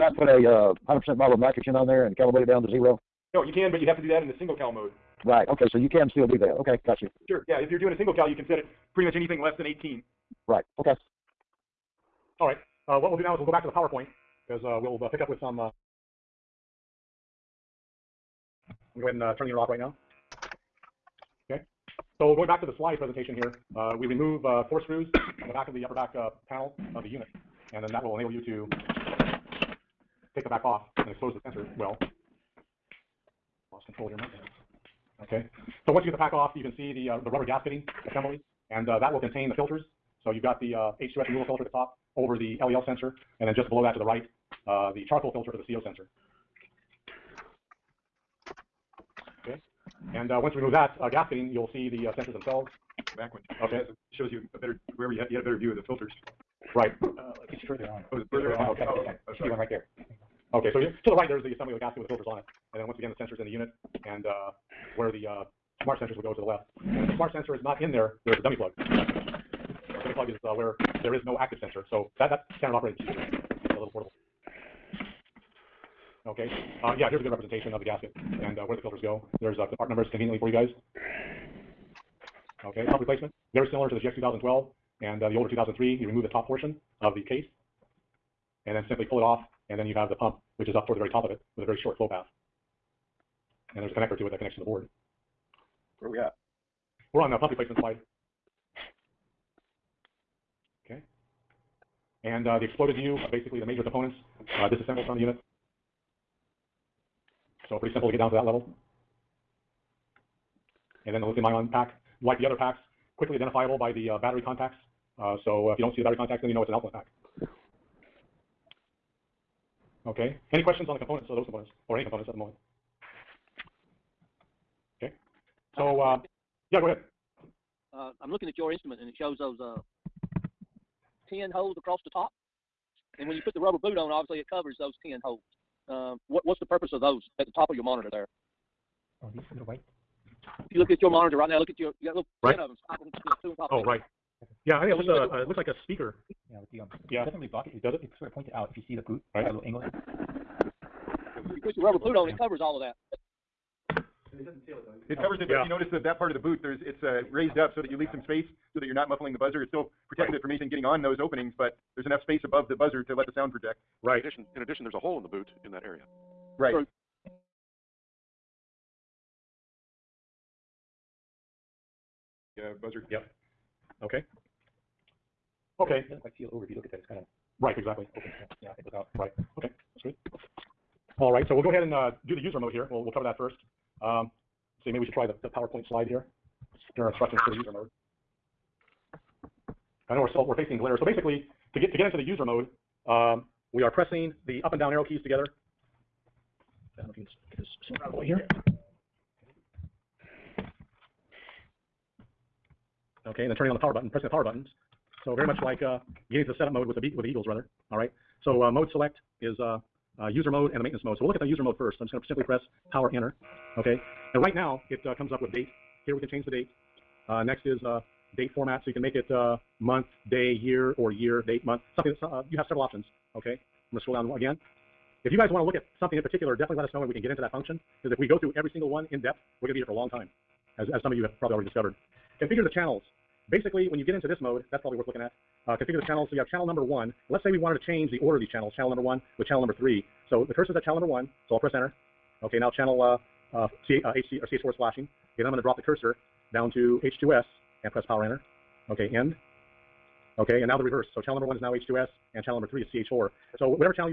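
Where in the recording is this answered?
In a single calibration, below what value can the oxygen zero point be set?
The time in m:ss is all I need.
0:09.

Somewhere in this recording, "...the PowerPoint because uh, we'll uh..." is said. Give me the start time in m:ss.
0:13.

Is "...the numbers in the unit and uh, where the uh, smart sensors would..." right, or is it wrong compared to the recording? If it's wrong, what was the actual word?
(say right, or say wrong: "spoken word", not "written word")
wrong: "sensors", not "numbers".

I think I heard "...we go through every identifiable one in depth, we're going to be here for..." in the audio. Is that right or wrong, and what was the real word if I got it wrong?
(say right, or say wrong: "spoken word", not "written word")
wrong: "single", not "identifiable".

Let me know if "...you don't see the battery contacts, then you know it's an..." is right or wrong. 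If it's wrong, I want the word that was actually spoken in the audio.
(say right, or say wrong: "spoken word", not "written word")
right.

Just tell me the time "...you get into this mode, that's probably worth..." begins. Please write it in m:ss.
3:53.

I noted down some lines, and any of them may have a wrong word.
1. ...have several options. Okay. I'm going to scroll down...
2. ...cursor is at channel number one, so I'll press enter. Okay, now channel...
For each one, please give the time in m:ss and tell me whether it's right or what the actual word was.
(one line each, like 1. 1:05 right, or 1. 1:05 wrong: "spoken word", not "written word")
1. 3:42 right
2. 4:00 right.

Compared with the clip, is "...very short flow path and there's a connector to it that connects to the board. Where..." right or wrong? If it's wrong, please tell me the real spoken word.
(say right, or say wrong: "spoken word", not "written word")
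right.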